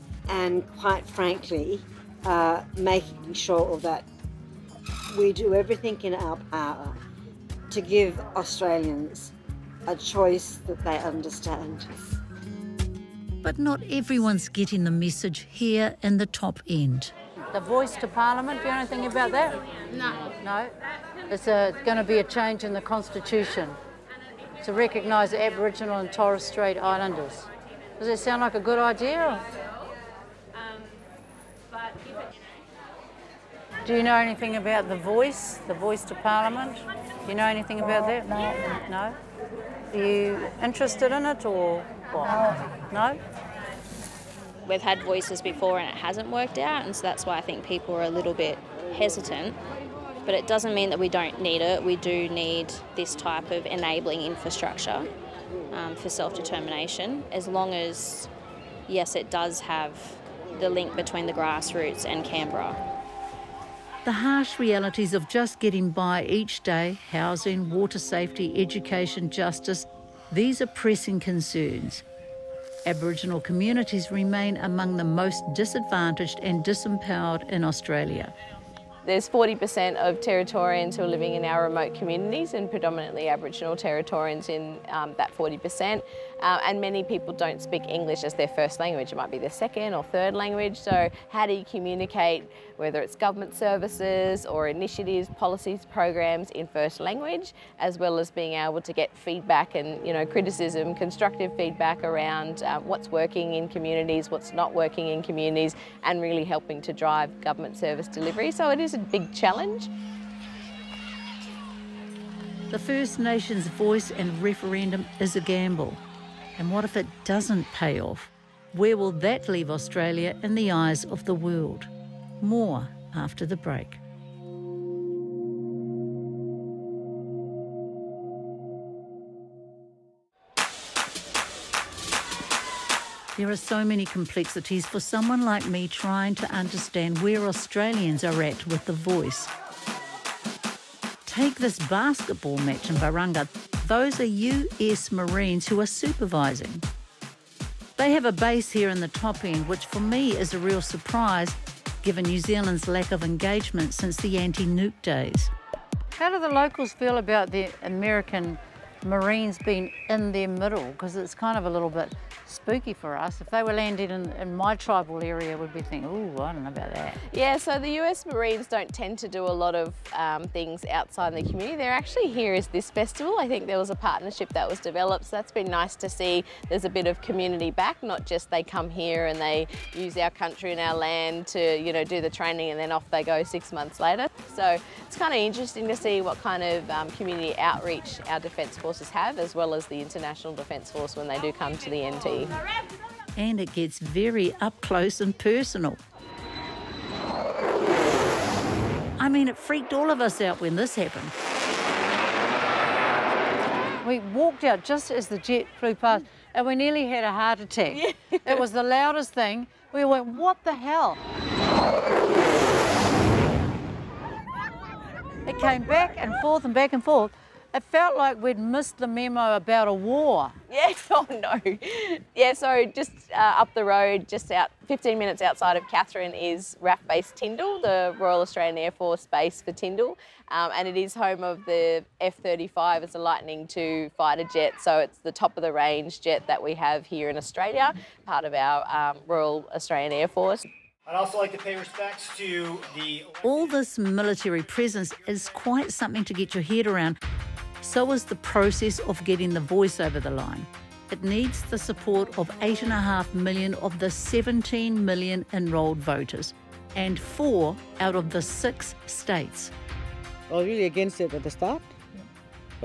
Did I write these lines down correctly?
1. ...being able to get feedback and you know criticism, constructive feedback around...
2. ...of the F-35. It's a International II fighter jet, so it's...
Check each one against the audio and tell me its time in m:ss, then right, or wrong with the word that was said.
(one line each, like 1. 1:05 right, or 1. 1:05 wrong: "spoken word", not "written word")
1. 1:38 right
2. 3:51 wrong: "Lightning", not "International".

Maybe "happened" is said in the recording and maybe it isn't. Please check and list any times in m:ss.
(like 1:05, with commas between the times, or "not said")
3:20.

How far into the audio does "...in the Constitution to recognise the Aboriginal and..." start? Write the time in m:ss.
0:22.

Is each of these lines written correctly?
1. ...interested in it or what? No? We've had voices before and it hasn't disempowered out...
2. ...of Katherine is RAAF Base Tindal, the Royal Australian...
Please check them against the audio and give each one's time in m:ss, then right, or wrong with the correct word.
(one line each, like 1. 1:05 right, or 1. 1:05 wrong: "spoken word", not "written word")
1. 0:40 wrong: "worked", not "disempowered"
2. 3:45 right.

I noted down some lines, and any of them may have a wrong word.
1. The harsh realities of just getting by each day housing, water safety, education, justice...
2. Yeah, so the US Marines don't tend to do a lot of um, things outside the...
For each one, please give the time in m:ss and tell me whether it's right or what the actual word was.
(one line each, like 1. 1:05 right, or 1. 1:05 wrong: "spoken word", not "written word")
1. 1:04 right
2. 2:47 right.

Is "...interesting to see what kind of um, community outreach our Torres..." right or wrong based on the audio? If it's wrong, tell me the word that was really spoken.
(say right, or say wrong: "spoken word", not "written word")
wrong: "Defence", not "Torres".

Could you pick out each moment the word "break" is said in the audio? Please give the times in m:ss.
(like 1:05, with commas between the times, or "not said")
2:03.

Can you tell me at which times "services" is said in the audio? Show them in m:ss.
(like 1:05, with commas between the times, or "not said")
1:33, 1:47.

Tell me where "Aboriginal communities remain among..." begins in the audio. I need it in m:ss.
1:12.